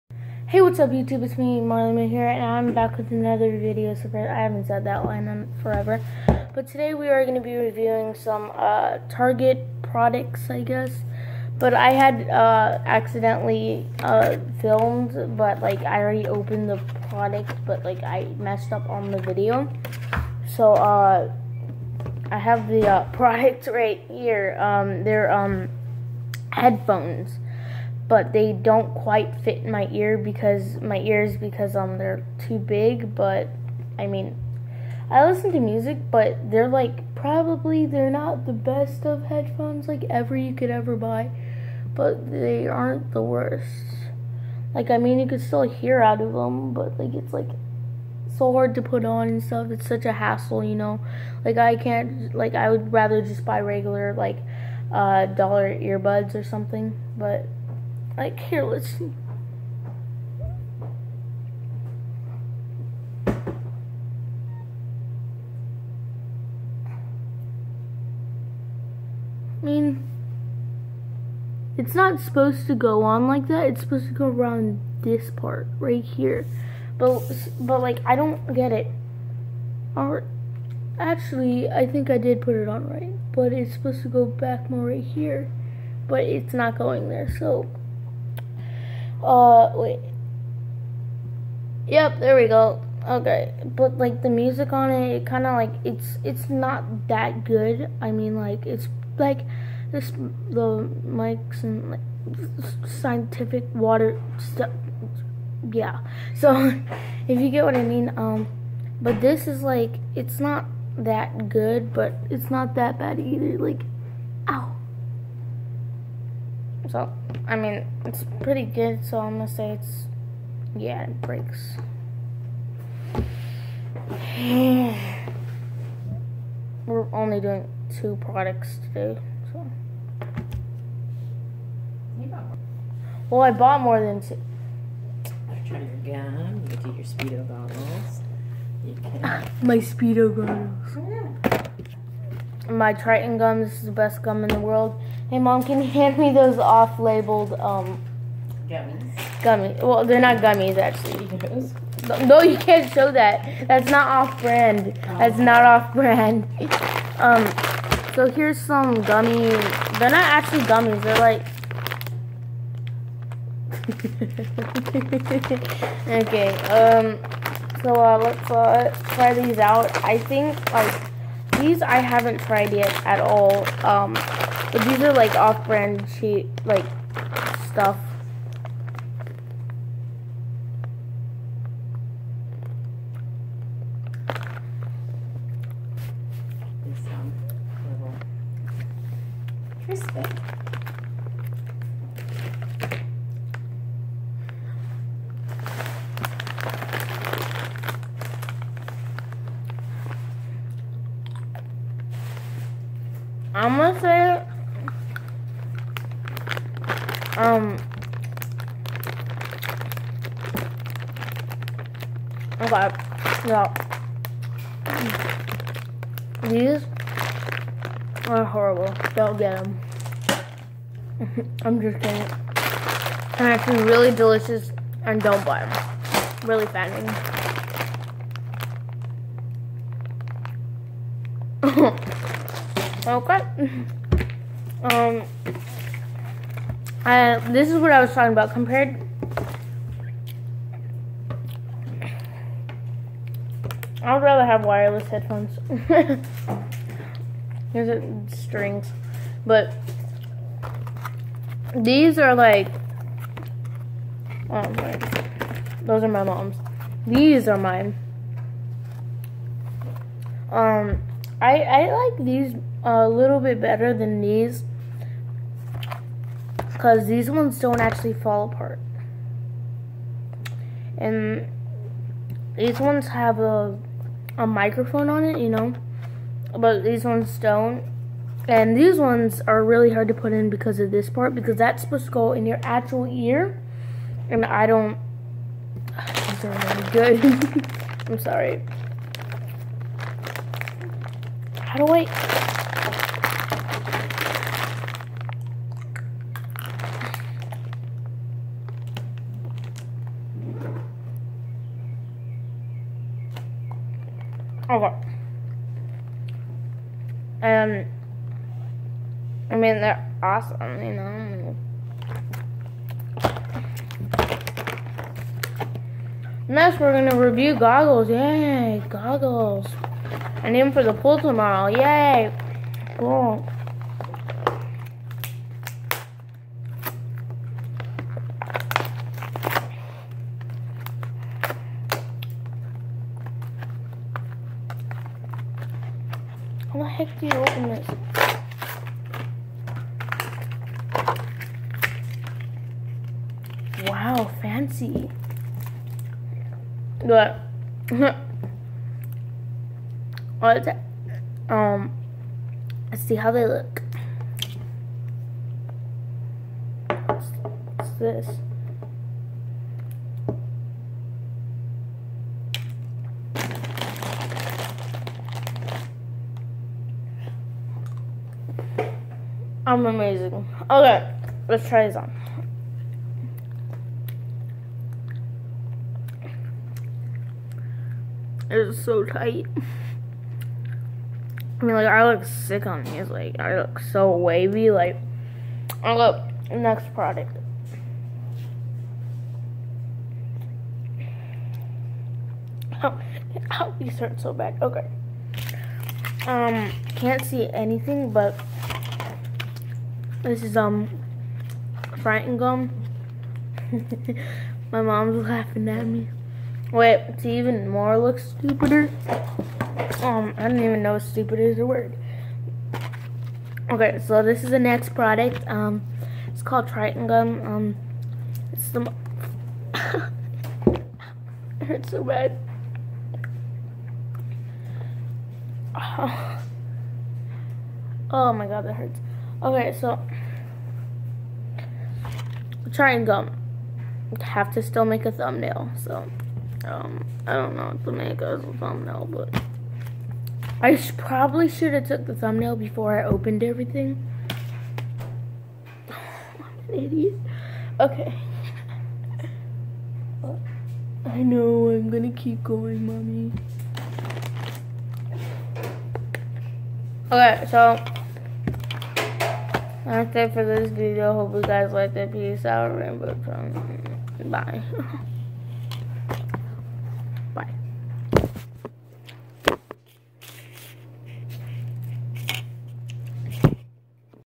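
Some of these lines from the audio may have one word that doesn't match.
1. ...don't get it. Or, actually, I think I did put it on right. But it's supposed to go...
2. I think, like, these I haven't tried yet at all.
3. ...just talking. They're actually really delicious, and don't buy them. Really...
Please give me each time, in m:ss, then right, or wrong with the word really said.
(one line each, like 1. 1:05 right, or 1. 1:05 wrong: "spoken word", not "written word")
1. 1:18 right
2. 2:50 right
3. 3:41 wrong: "kidding", not "talking".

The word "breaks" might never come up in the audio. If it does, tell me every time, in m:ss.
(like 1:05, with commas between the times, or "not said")
2:01.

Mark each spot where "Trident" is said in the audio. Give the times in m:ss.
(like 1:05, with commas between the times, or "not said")
2:22, 6:56.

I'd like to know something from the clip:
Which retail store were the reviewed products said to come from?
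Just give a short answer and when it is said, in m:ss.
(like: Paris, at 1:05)
Target, at 0:09.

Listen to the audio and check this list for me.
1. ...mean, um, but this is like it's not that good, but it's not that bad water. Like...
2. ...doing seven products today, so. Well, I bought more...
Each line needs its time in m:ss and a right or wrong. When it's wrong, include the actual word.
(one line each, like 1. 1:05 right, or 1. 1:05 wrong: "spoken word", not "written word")
1. 1:47 wrong: "either", not "water"
2. 2:07 wrong: "two", not "seven".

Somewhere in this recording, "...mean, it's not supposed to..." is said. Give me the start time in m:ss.
1:09.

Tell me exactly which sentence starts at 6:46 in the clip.
Wait, it's even more looks stupider.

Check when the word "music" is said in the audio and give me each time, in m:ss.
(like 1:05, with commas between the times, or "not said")
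0:35, 1:34.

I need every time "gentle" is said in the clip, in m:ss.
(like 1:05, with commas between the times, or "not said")
not said.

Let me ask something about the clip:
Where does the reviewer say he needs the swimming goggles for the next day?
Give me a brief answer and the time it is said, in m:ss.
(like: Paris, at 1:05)
the pool, at 5:20.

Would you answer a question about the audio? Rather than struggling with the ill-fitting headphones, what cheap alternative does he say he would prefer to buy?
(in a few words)
dollar earbuds.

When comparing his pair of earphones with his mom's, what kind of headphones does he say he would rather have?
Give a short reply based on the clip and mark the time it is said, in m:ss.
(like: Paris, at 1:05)
wireless headphones, at 4:04.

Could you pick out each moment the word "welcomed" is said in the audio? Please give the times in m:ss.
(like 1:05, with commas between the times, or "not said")
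not said.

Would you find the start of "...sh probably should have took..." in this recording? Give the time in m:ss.
7:20.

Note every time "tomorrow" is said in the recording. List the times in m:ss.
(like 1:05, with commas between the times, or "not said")
5:21.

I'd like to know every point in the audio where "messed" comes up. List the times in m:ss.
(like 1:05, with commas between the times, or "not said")
0:18.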